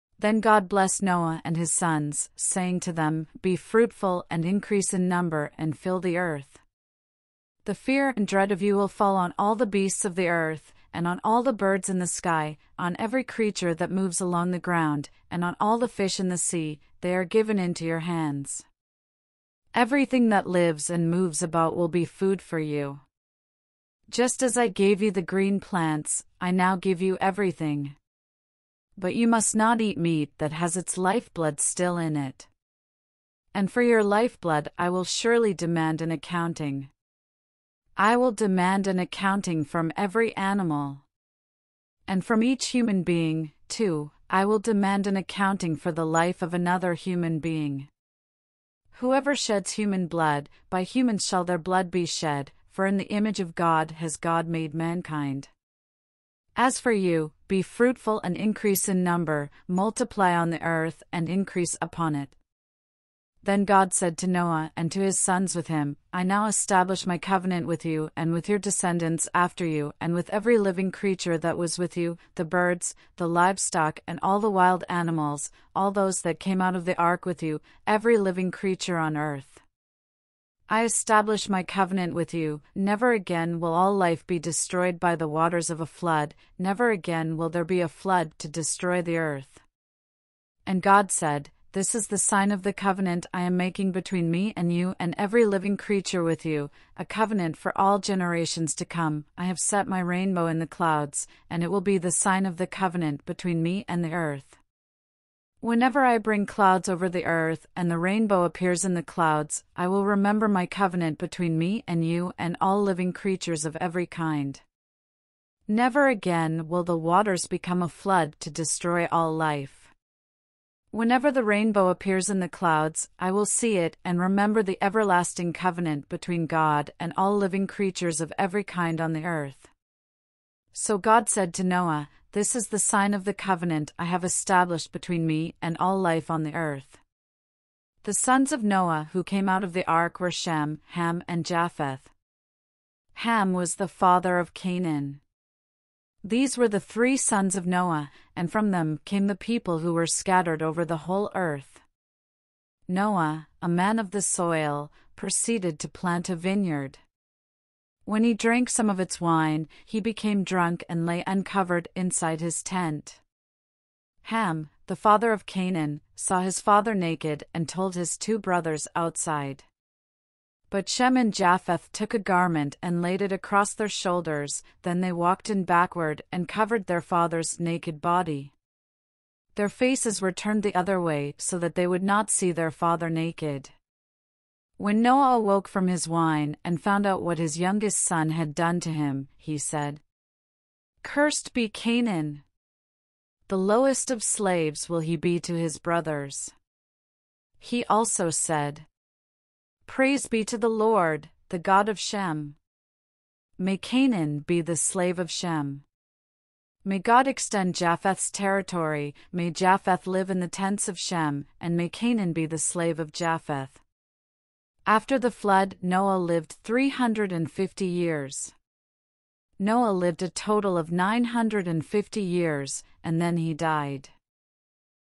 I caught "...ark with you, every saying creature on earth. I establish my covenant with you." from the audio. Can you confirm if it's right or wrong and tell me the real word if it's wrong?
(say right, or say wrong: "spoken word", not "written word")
wrong: "living", not "saying".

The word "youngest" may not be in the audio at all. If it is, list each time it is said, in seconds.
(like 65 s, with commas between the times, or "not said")
187 s.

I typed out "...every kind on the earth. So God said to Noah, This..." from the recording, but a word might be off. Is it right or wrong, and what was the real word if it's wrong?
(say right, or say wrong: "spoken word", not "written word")
right.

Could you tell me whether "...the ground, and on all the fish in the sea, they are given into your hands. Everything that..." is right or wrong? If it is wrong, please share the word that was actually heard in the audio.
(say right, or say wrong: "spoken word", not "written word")
right.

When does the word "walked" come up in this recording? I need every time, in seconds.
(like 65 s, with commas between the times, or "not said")
175 s.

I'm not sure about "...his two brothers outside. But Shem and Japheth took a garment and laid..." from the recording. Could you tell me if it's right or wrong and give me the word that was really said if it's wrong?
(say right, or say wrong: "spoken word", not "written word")
right.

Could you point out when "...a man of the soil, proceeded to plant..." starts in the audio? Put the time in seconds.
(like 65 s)
153 s.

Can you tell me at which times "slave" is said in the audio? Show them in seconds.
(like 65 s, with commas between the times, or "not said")
194 s, 204 s, 212 s.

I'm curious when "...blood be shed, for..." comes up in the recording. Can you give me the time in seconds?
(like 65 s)
51 s.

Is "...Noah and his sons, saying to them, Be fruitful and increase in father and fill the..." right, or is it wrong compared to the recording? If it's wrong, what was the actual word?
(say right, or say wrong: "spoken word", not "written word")
wrong: "number", not "father".